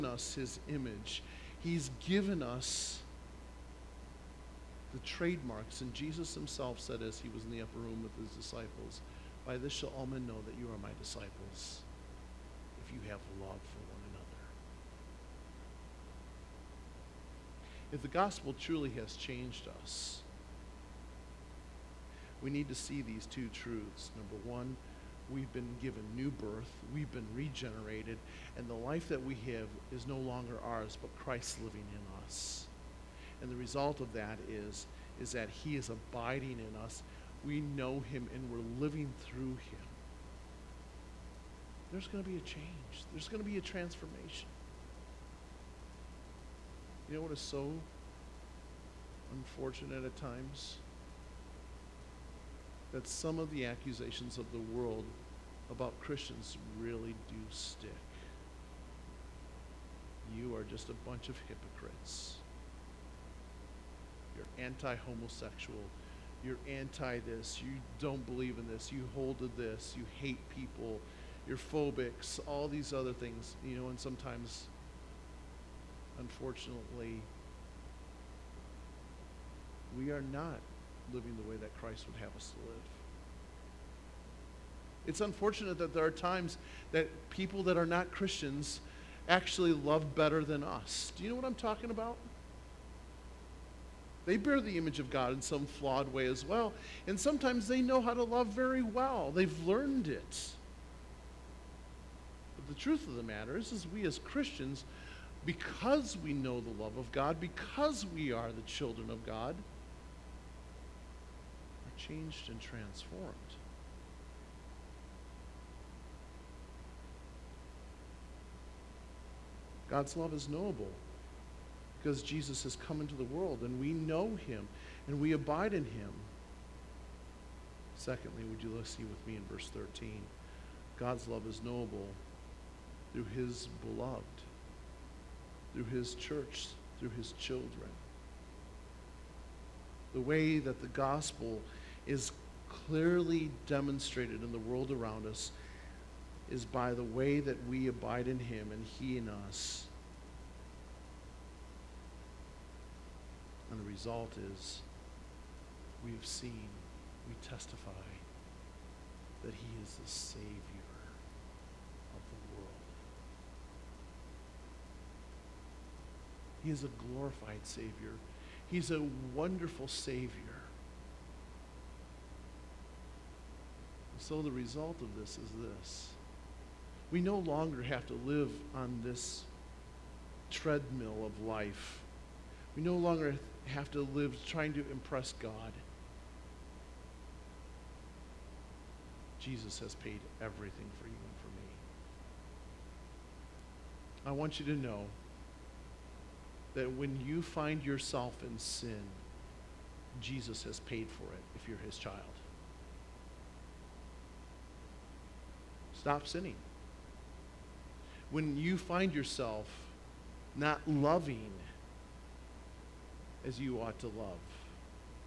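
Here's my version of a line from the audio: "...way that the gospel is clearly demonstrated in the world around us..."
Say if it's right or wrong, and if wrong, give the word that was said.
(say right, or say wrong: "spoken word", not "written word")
right.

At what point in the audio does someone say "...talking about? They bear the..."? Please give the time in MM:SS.
01:31.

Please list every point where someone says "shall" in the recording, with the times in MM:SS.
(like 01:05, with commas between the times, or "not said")
00:09.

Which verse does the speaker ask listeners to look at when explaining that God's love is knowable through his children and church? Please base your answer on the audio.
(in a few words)
Verse 13.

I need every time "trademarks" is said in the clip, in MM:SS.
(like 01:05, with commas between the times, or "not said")
00:04.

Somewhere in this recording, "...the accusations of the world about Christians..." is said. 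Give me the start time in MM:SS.
00:53.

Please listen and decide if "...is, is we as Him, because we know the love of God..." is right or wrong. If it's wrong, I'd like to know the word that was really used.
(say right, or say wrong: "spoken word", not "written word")
wrong: "Christians", not "Him".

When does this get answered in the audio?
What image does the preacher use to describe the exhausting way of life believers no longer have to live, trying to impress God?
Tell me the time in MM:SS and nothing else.
03:00.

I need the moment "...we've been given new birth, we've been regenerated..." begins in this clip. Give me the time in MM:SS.
00:25.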